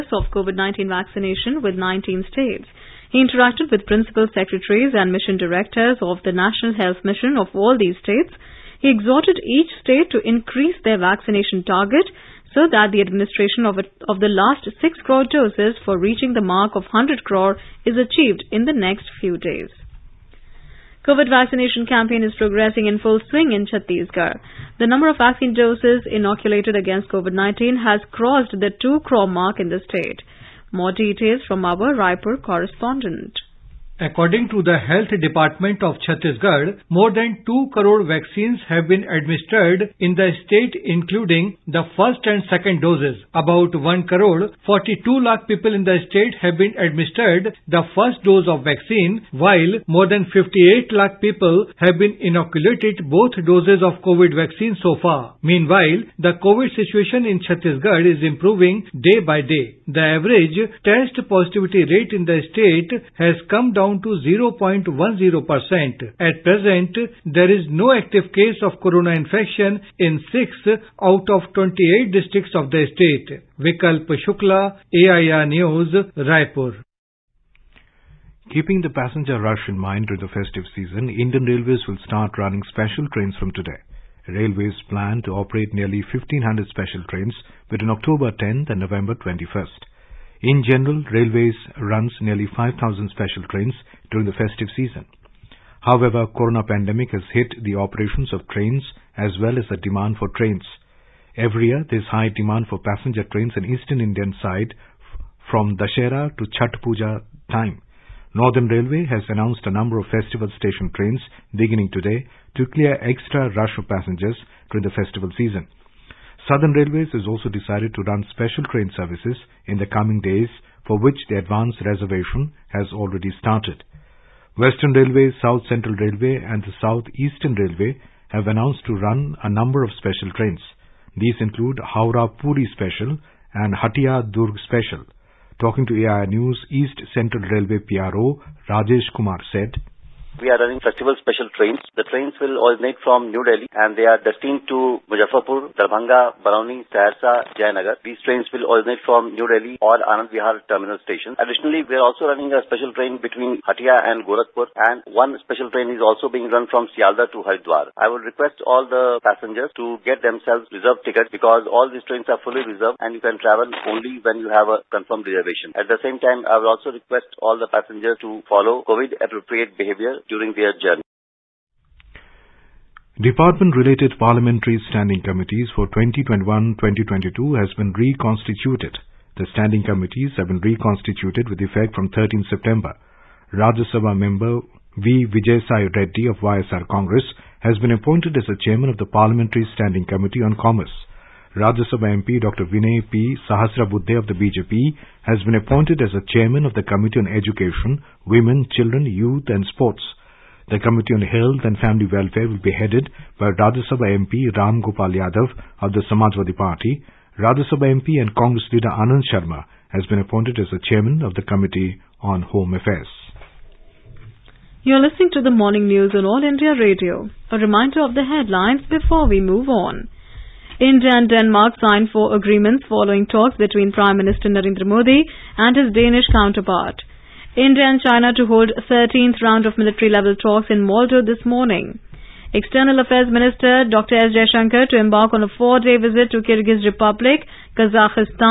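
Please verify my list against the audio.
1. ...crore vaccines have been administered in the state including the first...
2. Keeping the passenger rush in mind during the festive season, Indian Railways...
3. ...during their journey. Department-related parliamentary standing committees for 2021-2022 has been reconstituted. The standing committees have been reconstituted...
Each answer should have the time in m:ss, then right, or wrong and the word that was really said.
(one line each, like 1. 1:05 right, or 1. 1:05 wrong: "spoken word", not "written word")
1. 0:37 right
2. 1:18 right
3. 2:50 right.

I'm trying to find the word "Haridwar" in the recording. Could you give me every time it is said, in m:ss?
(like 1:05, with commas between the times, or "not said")
2:37.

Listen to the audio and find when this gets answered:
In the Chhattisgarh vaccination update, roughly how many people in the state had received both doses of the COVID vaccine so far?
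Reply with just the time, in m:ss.
0:50.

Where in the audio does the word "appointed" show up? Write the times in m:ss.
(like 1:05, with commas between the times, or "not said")
3:07, 3:15, 3:30.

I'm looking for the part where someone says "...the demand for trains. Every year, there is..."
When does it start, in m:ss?
1:39.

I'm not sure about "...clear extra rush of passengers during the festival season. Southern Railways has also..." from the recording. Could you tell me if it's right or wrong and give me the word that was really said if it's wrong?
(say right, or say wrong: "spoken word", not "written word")
right.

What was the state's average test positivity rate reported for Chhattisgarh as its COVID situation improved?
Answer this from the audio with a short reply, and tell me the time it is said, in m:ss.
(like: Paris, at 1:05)
0.10%, at 1:04.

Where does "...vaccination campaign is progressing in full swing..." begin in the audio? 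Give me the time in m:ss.
0:21.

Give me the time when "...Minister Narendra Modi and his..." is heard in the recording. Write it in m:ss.
3:44.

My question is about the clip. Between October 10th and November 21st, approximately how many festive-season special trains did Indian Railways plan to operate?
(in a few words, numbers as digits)
1500.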